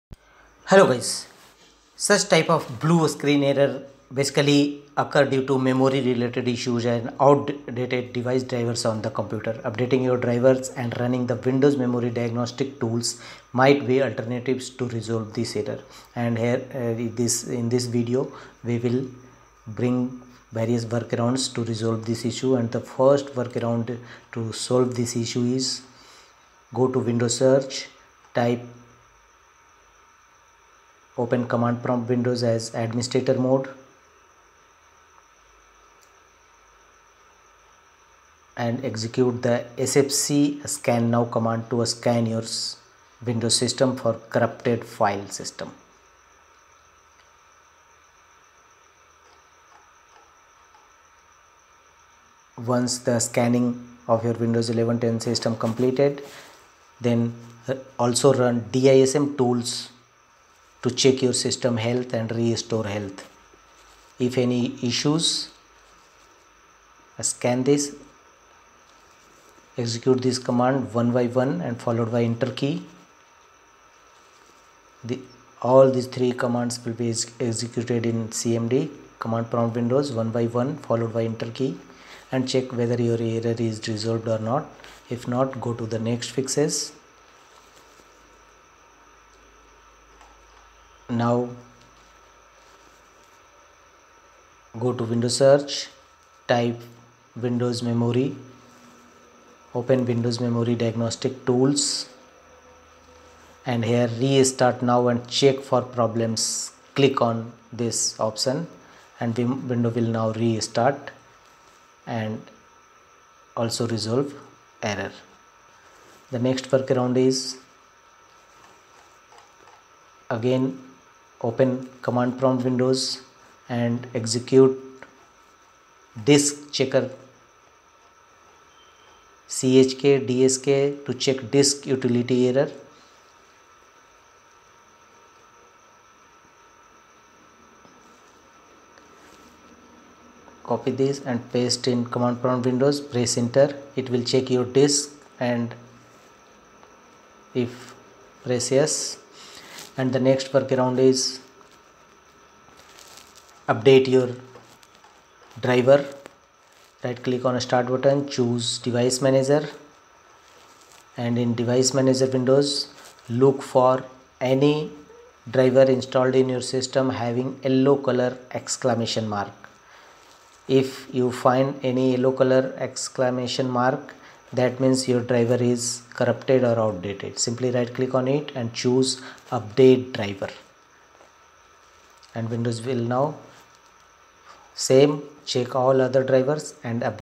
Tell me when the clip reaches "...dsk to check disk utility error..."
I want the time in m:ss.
2:10.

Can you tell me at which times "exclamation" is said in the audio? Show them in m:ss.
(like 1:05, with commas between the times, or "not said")
2:48, 2:52.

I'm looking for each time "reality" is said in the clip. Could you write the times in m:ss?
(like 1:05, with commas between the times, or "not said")
not said.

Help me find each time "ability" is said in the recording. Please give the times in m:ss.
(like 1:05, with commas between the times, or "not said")
not said.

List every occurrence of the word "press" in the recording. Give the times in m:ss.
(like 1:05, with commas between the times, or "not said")
2:23, 2:28.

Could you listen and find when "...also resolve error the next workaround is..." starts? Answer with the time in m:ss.
1:53.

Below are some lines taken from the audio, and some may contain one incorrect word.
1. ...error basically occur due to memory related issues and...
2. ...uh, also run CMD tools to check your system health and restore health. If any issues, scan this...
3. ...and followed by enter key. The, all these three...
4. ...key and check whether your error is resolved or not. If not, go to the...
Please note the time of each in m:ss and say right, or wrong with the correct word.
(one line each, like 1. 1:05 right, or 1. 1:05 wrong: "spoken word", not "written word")
1. 0:03 right
2. 0:57 wrong: "DISM", not "CMD"
3. 1:11 right
4. 1:21 right.